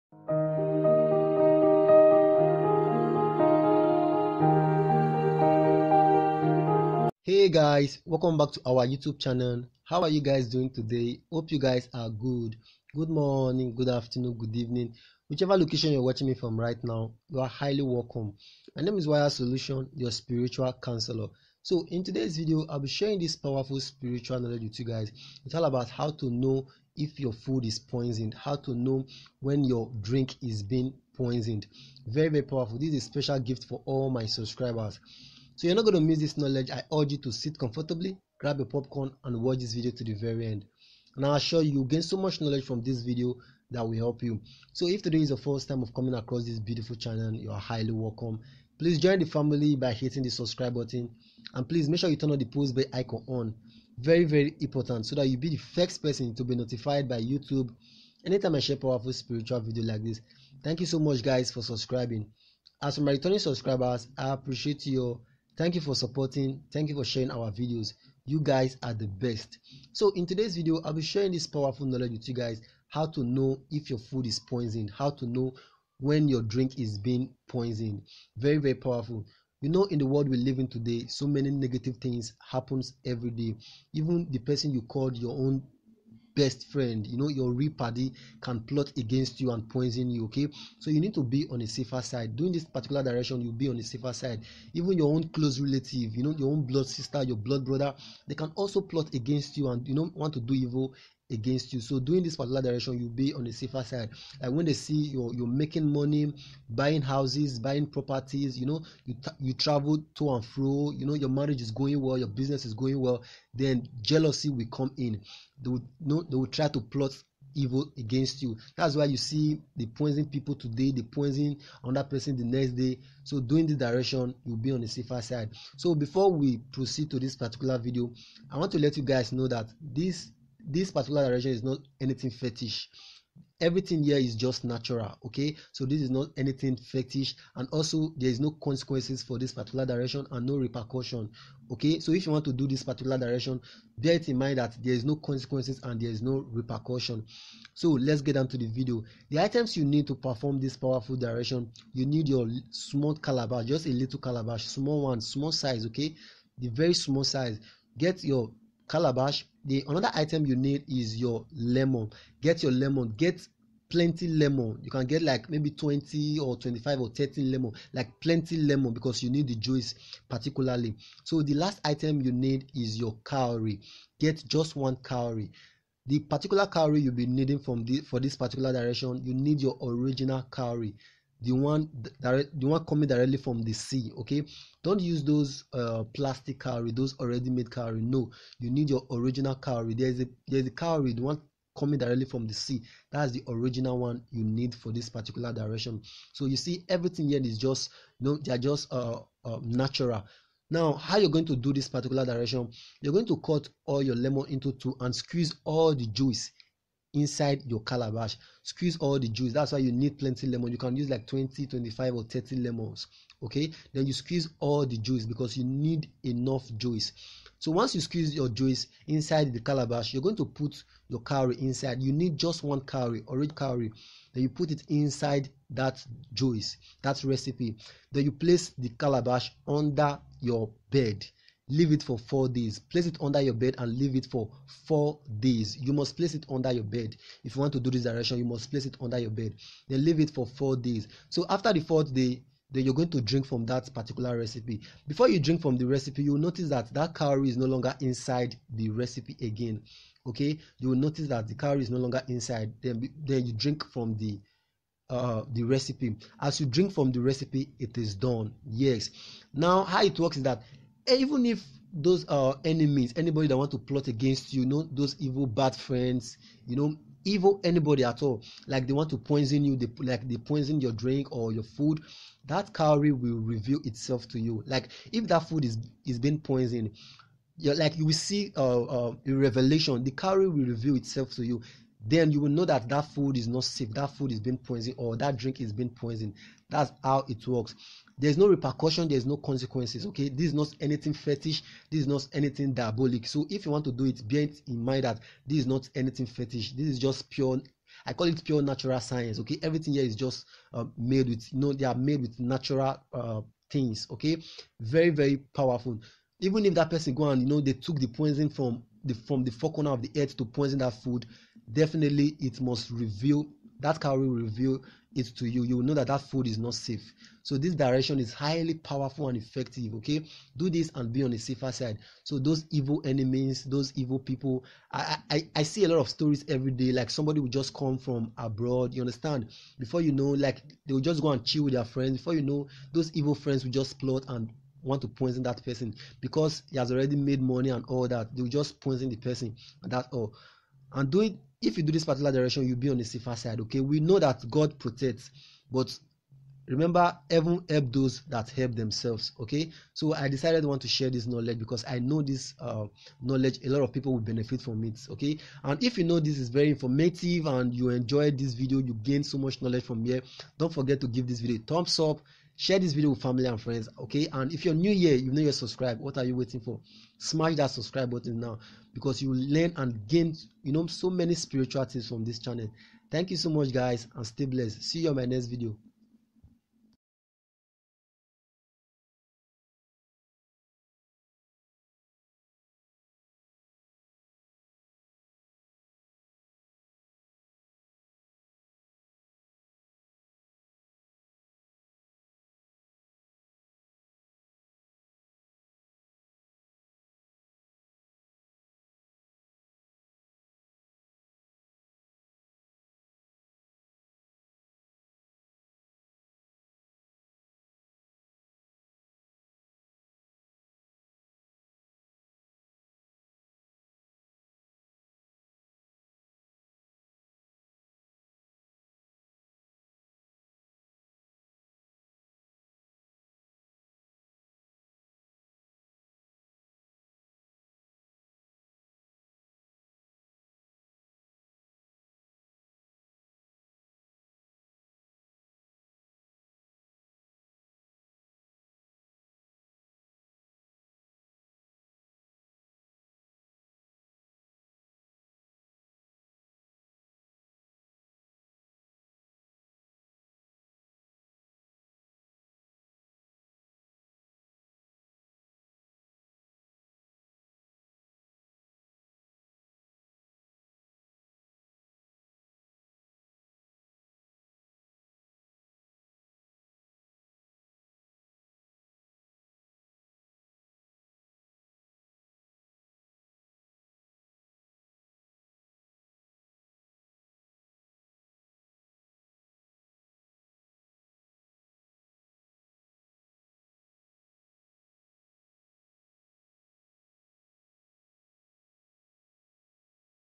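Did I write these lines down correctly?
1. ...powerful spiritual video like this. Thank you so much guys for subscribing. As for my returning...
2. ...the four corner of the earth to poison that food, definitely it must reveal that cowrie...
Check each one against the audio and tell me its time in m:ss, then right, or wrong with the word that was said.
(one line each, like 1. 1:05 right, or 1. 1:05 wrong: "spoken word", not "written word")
1. 0:58 right
2. 5:09 right.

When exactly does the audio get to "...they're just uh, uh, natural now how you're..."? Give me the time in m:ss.
3:18.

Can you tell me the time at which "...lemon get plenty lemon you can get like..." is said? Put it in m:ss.
2:42.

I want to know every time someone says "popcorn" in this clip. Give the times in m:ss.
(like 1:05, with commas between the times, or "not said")
0:38.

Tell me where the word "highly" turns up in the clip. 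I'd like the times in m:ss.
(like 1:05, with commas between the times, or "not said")
0:17, 0:47, 5:18.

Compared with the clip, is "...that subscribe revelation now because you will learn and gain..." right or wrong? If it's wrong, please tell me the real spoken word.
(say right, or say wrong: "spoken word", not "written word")
wrong: "button", not "revelation".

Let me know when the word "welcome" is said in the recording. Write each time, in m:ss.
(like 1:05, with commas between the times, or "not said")
0:08, 0:17, 0:47.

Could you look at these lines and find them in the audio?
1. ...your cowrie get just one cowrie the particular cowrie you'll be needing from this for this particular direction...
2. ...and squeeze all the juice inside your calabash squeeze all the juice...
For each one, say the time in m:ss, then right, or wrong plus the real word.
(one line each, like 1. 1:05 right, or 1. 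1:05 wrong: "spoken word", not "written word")
1. 2:52 right
2. 3:24 right.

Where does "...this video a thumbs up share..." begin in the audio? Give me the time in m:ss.
6:01.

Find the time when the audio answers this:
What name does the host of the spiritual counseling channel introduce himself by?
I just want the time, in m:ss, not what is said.
0:19.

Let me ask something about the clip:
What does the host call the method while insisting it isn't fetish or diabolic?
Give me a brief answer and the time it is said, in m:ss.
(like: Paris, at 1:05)
Pure natural science, at 4:58.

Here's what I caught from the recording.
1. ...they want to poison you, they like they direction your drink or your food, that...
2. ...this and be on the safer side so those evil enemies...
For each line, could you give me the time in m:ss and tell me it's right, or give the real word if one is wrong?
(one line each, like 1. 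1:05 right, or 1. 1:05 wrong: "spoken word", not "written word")
1. 4:28 wrong: "poison", not "direction"
2. 5:20 right.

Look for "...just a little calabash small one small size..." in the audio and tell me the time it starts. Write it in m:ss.
2:33.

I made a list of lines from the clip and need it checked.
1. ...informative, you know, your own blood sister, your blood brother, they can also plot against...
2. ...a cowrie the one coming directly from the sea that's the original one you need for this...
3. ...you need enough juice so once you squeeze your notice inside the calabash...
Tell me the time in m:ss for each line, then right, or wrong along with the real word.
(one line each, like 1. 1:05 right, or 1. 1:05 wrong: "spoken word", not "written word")
1. 1:35 wrong: "relative", not "informative"
2. 3:10 right
3. 3:35 wrong: "juice", not "notice".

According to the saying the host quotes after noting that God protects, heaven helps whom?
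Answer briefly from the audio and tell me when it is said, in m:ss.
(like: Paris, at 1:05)
Those that help themselves, at 5:47.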